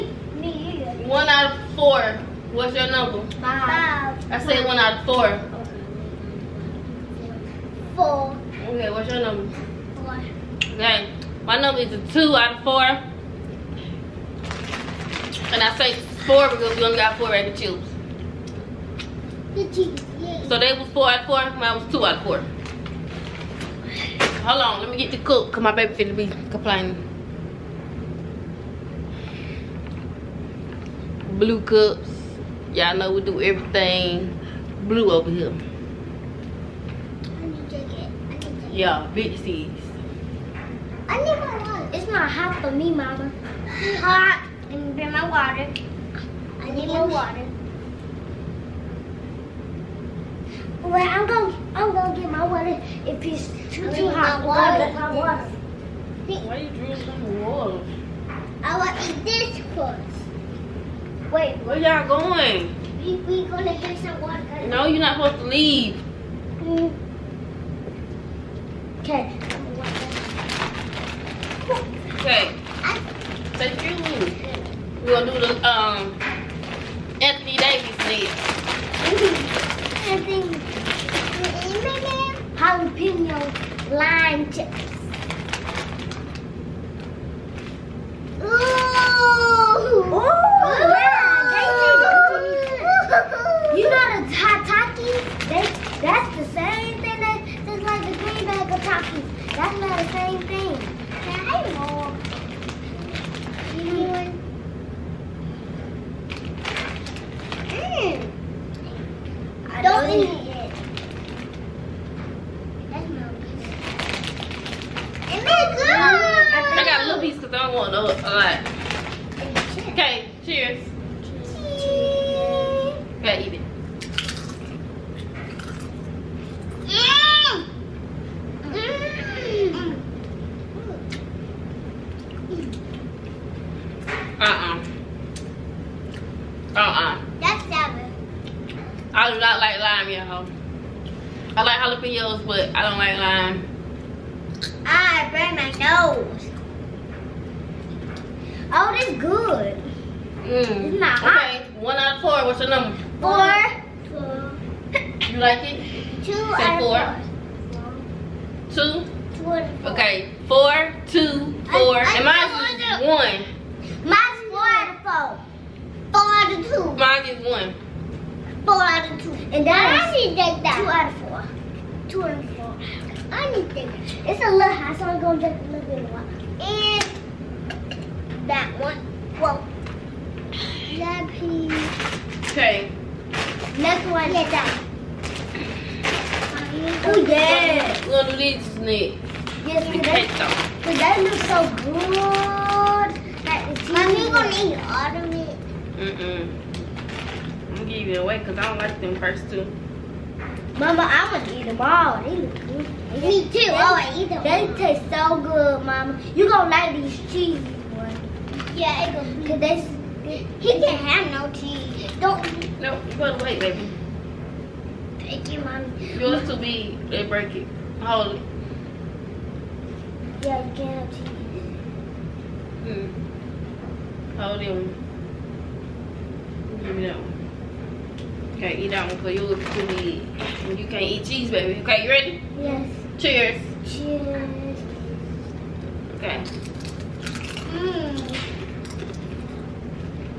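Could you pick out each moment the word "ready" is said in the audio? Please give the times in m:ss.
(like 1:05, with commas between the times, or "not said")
3:52.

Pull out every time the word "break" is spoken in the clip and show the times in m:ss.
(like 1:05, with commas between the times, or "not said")
3:37.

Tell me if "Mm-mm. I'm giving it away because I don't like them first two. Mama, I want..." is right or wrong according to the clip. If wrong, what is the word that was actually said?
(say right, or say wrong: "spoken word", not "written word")
right.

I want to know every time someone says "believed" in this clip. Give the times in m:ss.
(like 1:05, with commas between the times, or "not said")
not said.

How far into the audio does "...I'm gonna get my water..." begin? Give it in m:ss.
0:51.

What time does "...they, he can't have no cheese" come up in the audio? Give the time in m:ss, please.
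3:29.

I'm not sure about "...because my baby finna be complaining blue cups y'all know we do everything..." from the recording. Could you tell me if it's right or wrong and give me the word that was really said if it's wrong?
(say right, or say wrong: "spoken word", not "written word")
right.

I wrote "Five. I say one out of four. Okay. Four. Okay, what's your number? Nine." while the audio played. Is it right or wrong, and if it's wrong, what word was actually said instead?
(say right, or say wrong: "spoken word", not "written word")
wrong: "Four", not "Nine".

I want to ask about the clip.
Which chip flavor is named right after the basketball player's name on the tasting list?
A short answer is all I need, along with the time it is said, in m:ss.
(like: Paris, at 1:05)
jalapeno lime, at 1:22.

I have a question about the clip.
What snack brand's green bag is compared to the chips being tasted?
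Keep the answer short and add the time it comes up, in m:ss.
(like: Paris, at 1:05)
Takis, at 1:38.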